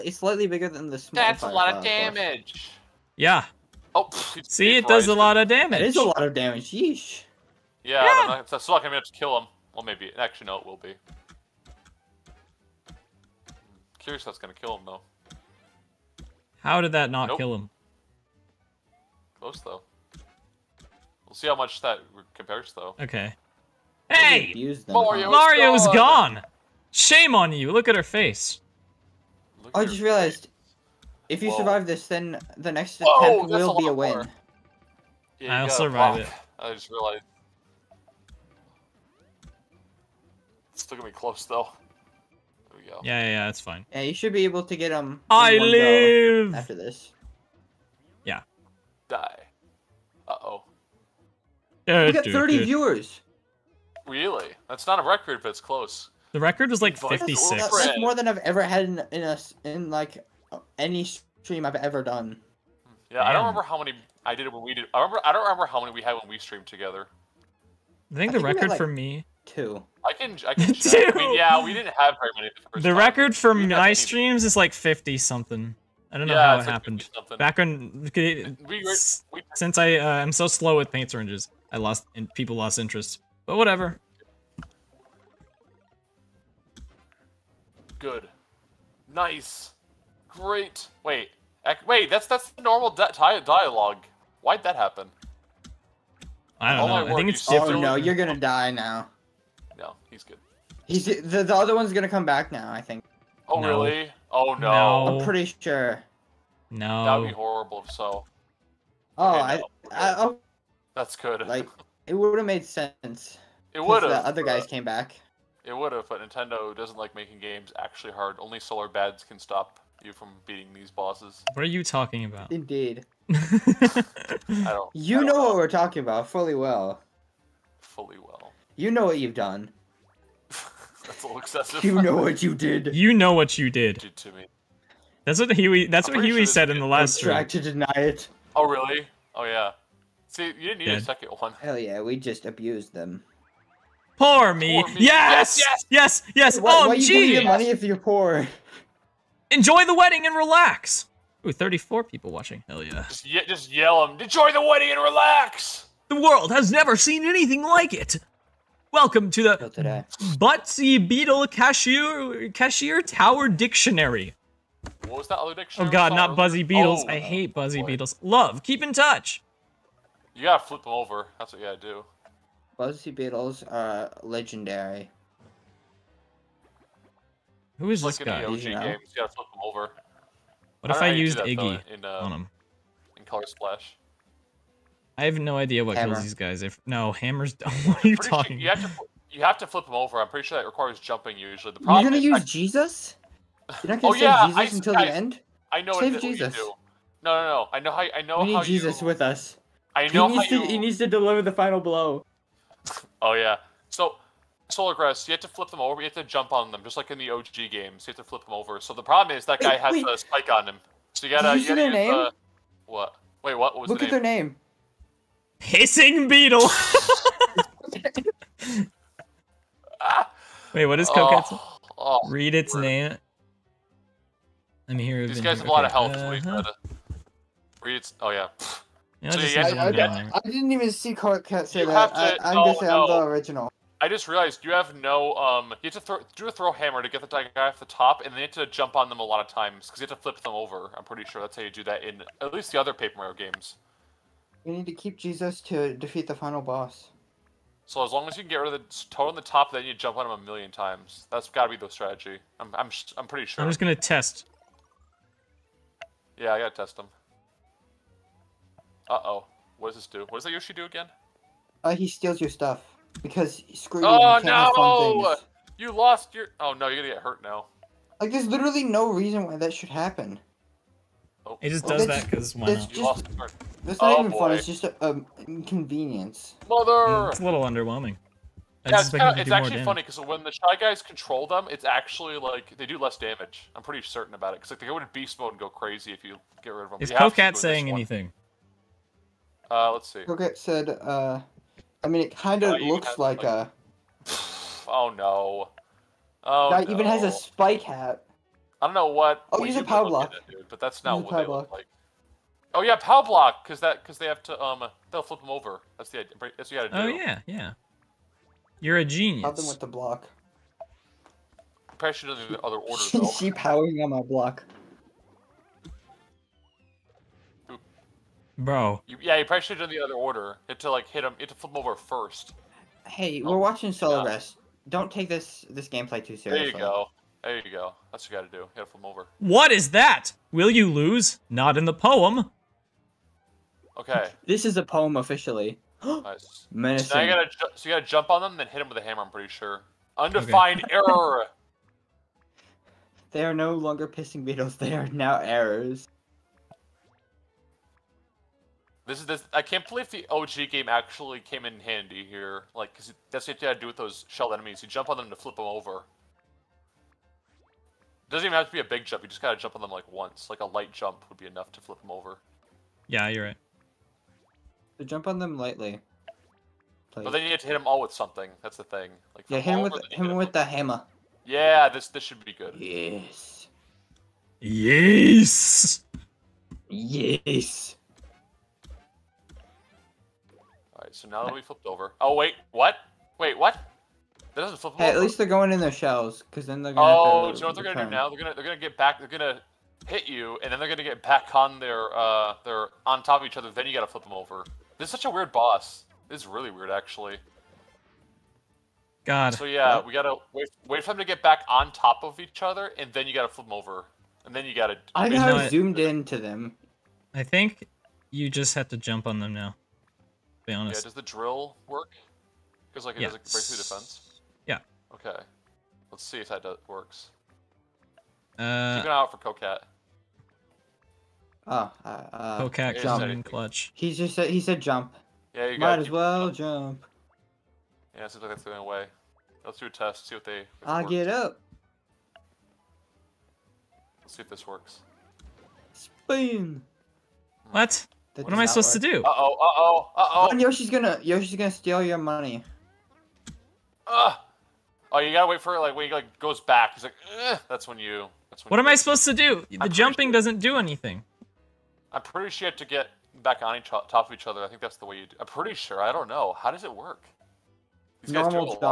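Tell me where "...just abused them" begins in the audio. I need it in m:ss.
2:22.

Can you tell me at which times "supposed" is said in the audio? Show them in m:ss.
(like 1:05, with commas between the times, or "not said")
7:18, 7:28.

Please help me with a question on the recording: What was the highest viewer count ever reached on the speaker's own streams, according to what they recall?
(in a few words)
56.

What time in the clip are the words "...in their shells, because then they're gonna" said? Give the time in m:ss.
6:25.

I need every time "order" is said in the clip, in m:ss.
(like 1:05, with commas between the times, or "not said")
5:12, 5:20.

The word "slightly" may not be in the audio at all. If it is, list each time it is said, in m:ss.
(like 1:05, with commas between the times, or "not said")
0:00.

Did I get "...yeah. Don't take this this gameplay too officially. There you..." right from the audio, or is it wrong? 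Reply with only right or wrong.
wrong.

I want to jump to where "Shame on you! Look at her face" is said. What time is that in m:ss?
0:26.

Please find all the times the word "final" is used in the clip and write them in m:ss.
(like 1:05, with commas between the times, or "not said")
3:21, 4:06.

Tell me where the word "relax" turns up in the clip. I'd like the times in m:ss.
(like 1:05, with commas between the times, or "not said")
2:30, 2:35.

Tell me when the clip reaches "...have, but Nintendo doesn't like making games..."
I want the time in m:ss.
1:55.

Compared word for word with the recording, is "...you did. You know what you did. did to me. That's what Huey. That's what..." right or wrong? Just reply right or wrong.
right.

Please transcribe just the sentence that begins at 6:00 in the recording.
Like a light jump would be enough to flip them over.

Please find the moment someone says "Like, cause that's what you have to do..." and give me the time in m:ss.
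5:52.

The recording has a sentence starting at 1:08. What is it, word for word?
I think I the think record like for me two.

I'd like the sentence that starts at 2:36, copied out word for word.
The world has never seen anything like it.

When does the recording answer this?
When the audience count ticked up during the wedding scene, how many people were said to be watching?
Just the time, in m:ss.
2:31.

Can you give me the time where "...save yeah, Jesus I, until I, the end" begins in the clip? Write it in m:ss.
3:14.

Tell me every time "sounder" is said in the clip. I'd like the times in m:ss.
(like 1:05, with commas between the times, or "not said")
not said.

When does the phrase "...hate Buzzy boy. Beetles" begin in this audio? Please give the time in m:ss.
2:47.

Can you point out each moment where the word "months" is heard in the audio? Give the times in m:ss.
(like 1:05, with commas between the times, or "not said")
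not said.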